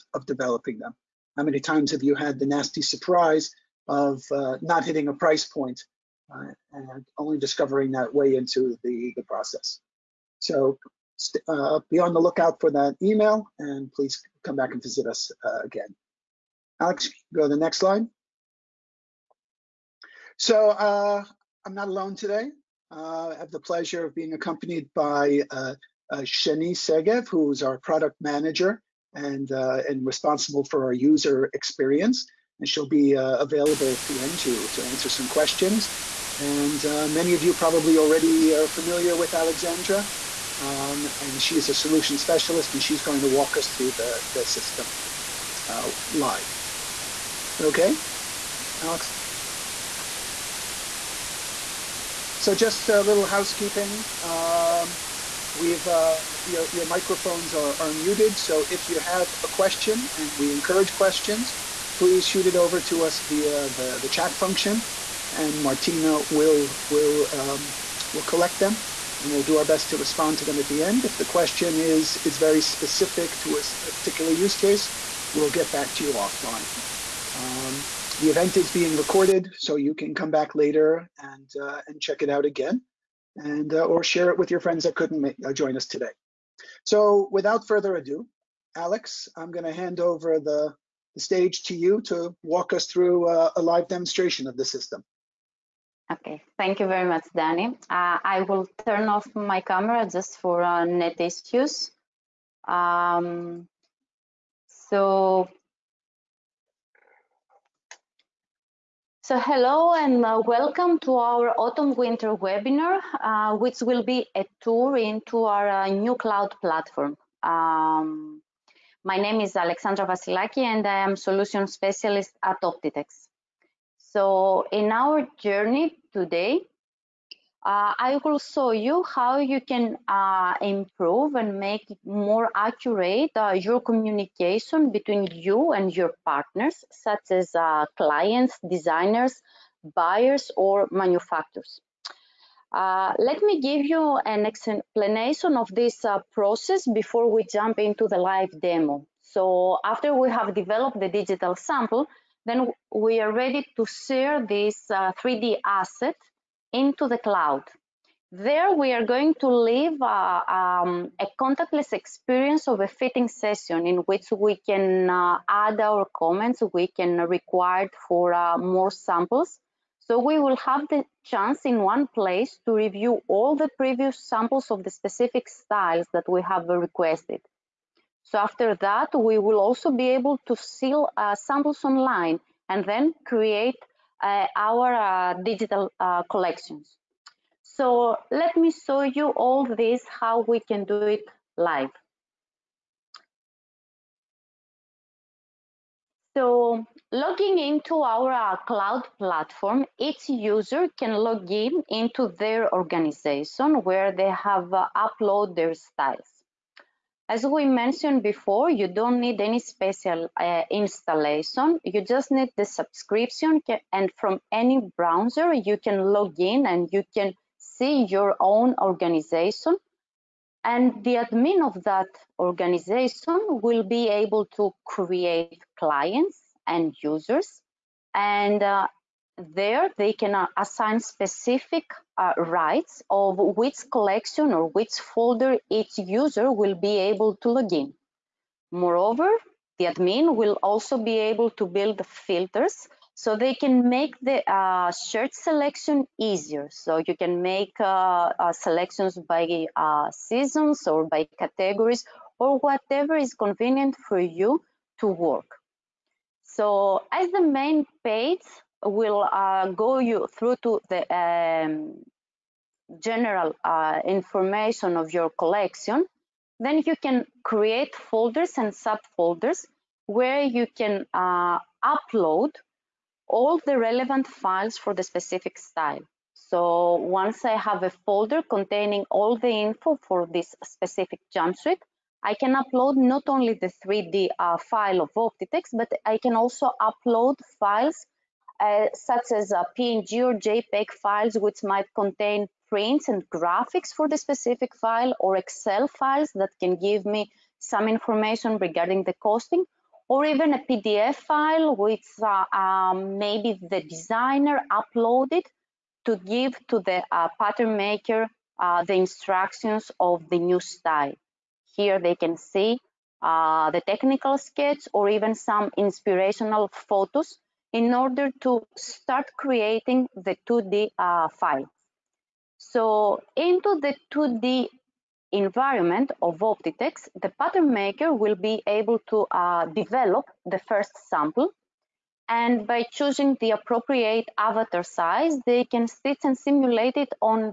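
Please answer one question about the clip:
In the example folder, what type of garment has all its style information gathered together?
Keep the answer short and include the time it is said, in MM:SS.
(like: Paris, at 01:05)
jumpsuit, at 04:41.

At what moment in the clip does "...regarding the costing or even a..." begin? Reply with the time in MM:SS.
04:58.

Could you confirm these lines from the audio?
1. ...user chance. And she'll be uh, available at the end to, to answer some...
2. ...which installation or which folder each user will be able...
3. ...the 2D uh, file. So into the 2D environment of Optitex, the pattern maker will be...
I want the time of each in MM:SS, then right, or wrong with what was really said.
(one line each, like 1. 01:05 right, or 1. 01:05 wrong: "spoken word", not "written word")
1. 00:30 wrong: "experience", not "chance"
2. 03:53 wrong: "collection", not "installation"
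3. 05:20 right.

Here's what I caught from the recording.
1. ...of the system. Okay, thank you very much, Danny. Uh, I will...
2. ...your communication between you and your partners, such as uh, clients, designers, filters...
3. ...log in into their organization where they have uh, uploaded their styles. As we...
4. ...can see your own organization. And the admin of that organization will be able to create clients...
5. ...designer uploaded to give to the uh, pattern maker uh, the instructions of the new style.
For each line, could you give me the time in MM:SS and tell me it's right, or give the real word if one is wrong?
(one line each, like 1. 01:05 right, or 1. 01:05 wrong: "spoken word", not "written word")
1. 01:34 right
2. 02:13 wrong: "buyers", not "filters"
3. 03:21 right
4. 03:37 right
5. 05:03 right.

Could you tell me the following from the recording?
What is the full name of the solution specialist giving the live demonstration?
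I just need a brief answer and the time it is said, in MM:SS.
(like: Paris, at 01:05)
Alexandra Vasilaki, at 01:59.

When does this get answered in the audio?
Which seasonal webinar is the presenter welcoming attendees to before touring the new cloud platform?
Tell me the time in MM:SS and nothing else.
01:51.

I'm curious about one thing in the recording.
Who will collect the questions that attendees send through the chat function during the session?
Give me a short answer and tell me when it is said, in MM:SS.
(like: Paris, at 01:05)
Martina, at 01:05.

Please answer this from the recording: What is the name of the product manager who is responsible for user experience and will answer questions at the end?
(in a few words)
Shani Segev.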